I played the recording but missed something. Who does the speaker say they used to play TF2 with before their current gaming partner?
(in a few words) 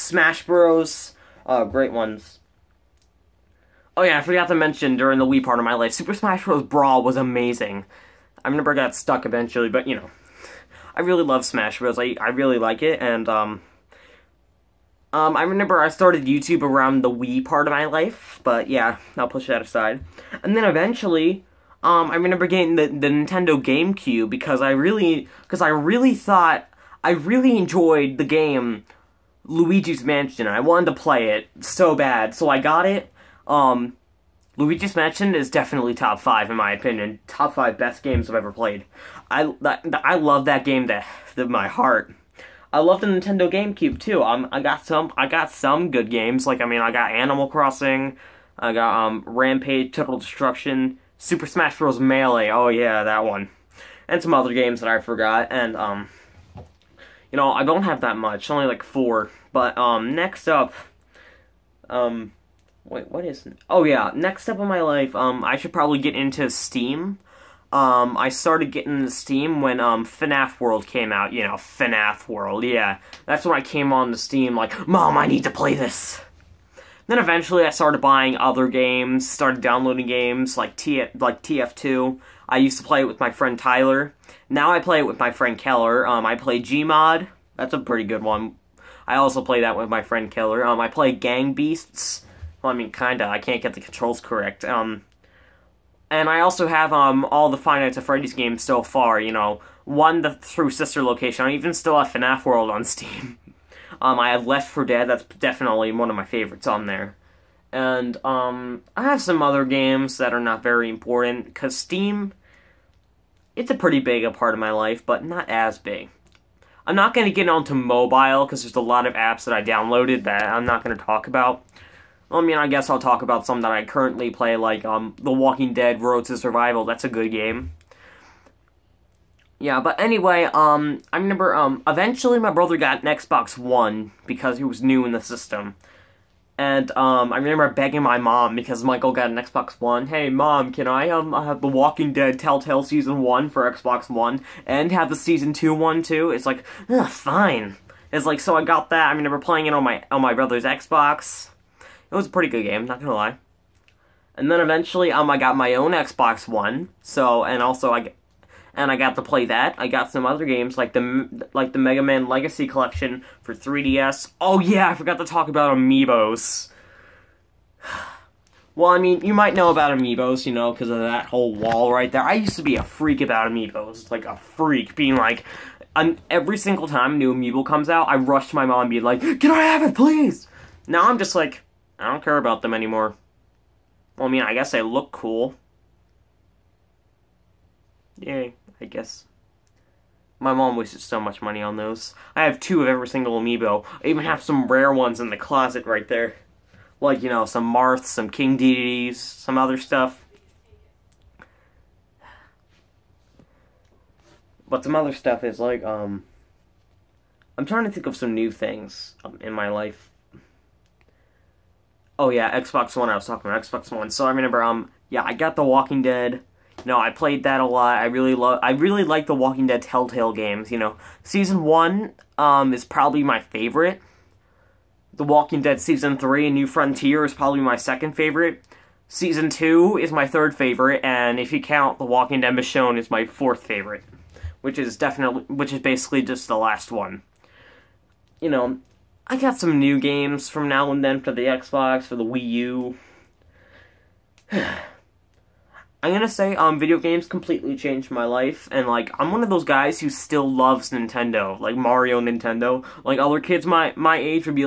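Tyler.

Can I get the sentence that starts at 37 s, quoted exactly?
Top five best games I've ever played.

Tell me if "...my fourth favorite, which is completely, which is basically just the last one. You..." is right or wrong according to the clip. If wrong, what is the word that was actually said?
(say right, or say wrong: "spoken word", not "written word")
wrong: "definitely", not "completely".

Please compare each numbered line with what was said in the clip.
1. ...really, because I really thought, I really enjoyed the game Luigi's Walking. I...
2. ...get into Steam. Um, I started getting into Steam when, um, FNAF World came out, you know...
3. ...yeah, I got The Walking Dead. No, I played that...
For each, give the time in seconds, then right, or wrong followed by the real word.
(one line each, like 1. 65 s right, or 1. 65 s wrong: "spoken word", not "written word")
1. 24 s wrong: "Mansion", not "Walking"
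2. 65 s right
3. 215 s right.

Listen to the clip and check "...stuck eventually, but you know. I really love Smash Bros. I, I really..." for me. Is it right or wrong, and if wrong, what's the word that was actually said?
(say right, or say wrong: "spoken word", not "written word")
right.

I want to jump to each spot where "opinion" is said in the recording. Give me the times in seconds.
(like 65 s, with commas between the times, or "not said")
36 s.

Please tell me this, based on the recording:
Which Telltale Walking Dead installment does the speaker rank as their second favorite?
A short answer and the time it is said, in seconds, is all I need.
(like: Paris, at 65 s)
New Frontier, at 226 s.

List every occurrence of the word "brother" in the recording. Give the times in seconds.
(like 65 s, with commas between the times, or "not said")
132 s, 150 s.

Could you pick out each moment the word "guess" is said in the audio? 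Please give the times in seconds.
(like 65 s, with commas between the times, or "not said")
122 s, 184 s, 188 s.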